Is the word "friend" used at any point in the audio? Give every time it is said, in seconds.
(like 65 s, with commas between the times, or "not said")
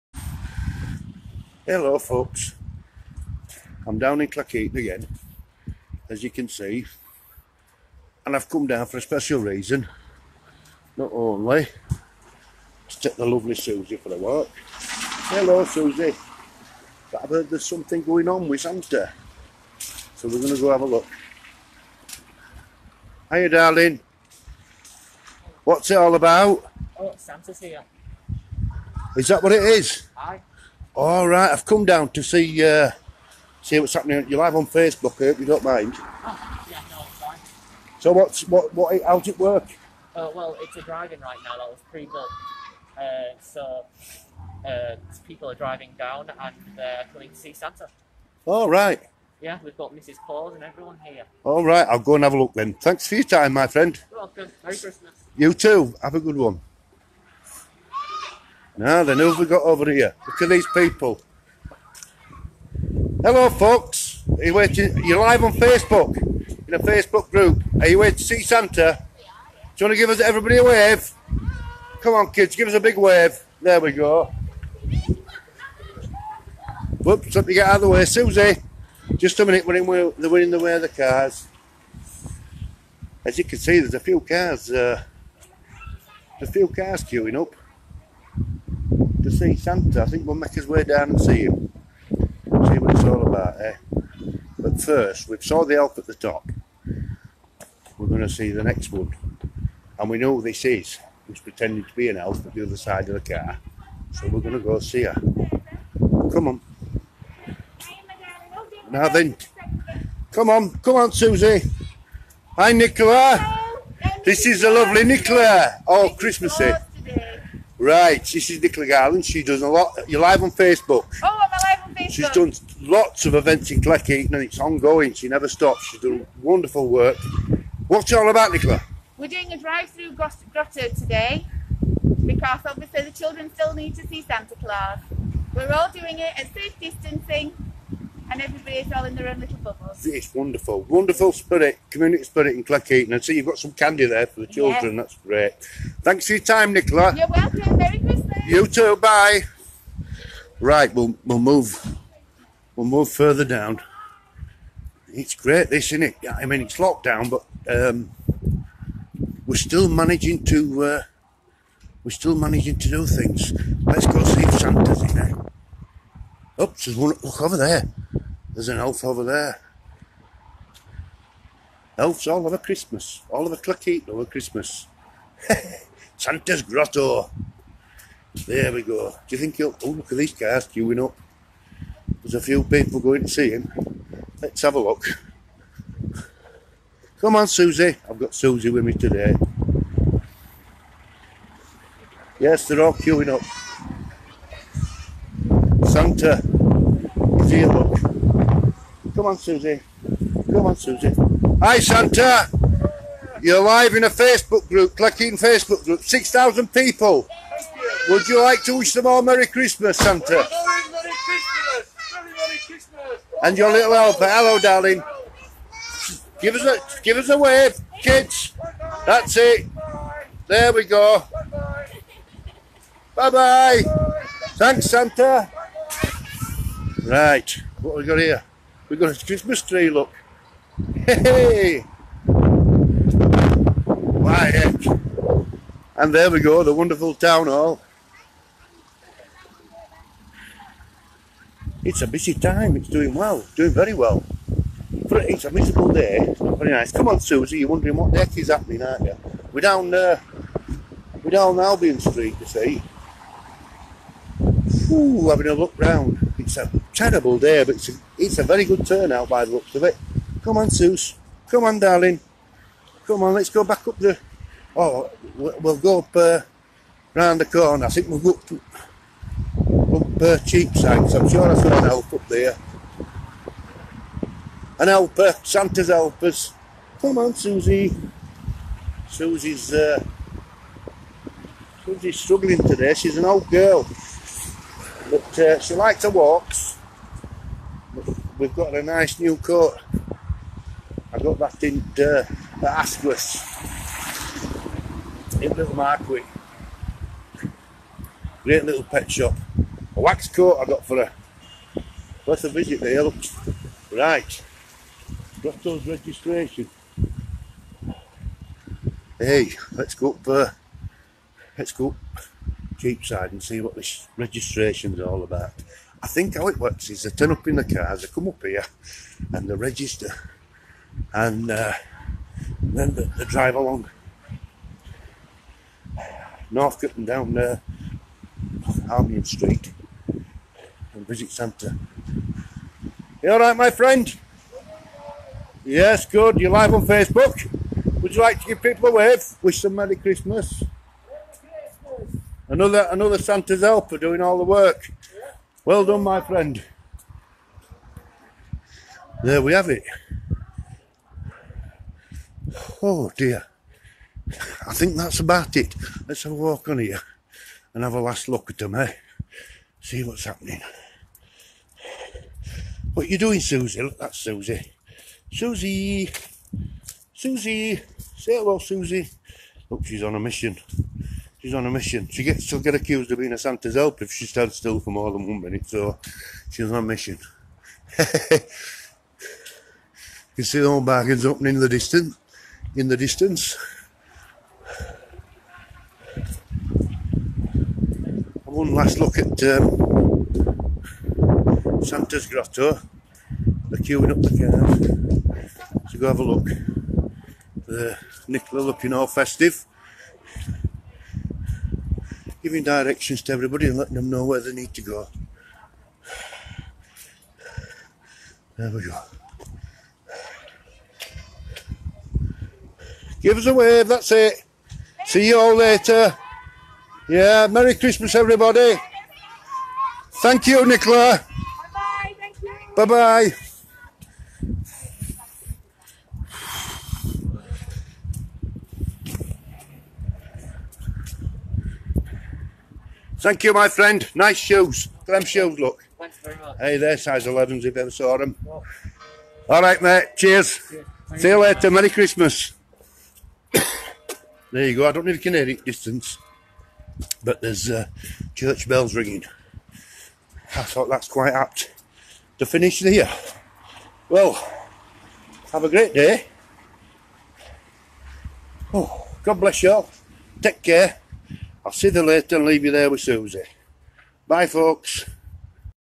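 53 s, 333 s, 346 s, 433 s.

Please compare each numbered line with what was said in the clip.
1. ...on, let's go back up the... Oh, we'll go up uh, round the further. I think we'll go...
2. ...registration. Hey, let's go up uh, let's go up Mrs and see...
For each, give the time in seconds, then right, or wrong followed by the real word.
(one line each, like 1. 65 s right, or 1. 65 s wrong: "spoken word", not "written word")
1. 263 s wrong: "corner", not "further"
2. 305 s wrong: "Cheapside", not "Mrs".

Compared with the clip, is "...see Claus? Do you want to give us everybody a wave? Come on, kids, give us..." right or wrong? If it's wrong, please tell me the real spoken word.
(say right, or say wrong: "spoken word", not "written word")
wrong: "Santa", not "Claus".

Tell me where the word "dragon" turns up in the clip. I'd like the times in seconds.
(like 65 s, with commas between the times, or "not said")
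40 s.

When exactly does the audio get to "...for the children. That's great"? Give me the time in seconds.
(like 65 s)
144 s.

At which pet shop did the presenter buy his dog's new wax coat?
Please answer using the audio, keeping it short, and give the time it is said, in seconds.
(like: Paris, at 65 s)
Asquith, at 292 s.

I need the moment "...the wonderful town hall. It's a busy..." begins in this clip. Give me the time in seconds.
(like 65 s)
236 s.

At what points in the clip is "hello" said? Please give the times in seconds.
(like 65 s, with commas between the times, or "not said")
1 s, 14 s, 63 s, 214 s, 368 s.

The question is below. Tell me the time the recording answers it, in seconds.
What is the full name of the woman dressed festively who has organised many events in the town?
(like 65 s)
118 s.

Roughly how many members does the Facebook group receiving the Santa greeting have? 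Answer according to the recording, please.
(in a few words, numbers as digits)
6,000.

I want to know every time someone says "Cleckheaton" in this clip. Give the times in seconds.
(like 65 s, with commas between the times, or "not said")
4 s, 123 s, 142 s, 173 s.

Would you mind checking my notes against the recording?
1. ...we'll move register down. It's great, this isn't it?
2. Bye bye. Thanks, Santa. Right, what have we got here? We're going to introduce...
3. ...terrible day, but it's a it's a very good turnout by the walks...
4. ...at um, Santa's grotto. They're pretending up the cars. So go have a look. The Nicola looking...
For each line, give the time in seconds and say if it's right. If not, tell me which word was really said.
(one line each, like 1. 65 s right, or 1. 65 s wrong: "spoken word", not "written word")
1. 152 s wrong: "further", not "register"
2. 223 s right
3. 256 s wrong: "looks", not "walks"
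4. 389 s wrong: "queuing", not "pretending".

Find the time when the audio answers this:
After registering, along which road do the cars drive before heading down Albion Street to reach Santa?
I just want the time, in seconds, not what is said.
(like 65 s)
326 s.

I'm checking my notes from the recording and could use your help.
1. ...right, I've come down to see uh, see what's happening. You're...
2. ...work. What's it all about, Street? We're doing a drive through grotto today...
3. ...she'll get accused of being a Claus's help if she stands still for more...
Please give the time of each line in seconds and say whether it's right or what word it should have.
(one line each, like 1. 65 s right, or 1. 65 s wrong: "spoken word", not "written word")
1. 31 s right
2. 126 s wrong: "Nicola", not "Street"
3. 372 s wrong: "Santa", not "Claus".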